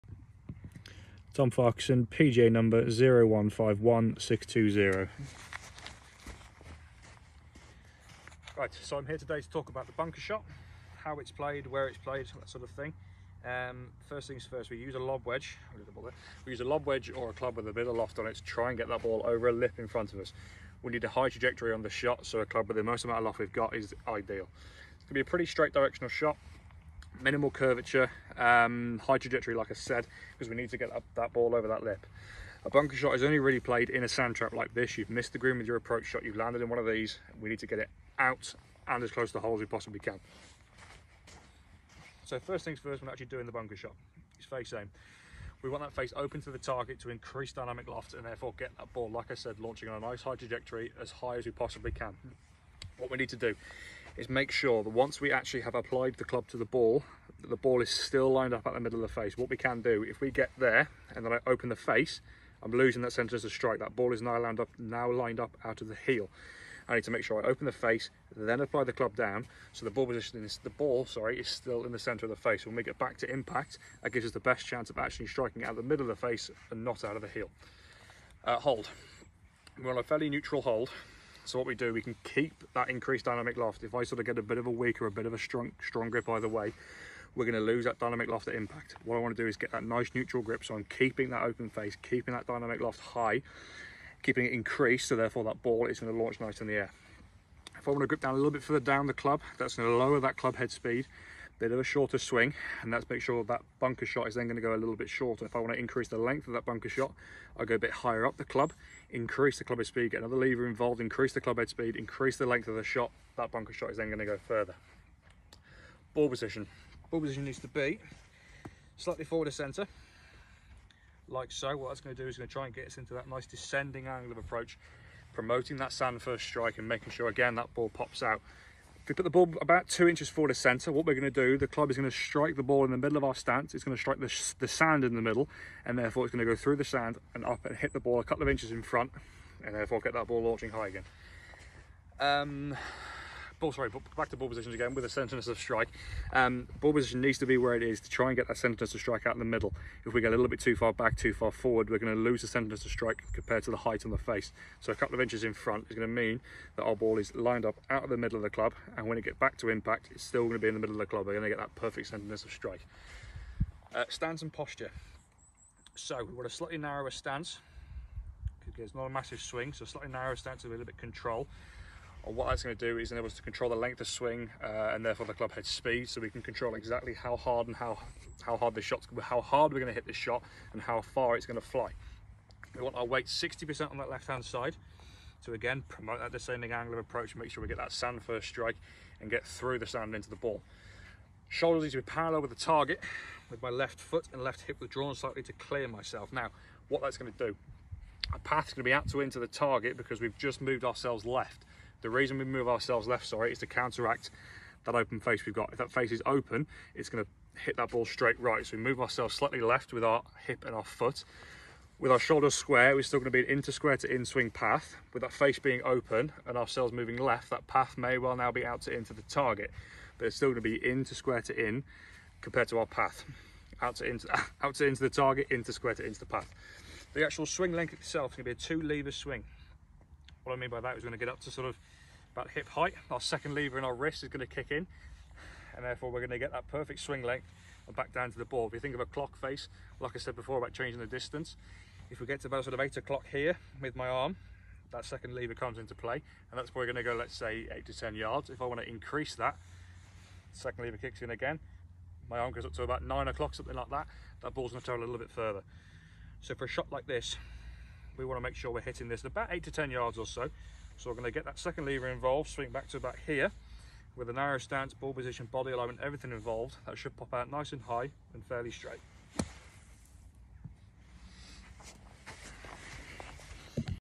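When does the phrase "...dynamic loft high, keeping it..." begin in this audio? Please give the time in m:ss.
1:32.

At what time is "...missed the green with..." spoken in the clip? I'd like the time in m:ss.
0:35.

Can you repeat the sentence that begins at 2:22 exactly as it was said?
Um, ball, sorry, back to ball positions again with a centerness of strike.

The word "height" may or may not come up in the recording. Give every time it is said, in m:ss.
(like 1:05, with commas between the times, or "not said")
2:33, 3:52.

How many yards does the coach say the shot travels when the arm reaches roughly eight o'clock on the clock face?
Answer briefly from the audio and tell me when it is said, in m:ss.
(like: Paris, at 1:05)
8 to 10 yards, at 4:07.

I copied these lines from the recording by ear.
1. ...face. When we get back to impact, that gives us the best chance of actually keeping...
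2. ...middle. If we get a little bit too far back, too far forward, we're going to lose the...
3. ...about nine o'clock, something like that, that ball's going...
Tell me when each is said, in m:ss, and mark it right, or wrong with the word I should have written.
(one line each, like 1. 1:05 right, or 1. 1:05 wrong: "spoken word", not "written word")
1. 1:12 wrong: "striking", not "keeping"
2. 2:29 right
3. 4:12 right.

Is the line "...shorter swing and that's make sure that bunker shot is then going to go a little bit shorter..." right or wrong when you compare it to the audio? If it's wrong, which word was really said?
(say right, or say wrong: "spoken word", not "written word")
right.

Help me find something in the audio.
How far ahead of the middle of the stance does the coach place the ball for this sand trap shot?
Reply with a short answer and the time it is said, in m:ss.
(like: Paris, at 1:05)
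2 inches, at 2:09.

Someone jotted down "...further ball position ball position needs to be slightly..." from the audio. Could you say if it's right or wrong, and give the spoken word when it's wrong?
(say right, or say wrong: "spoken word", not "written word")
right.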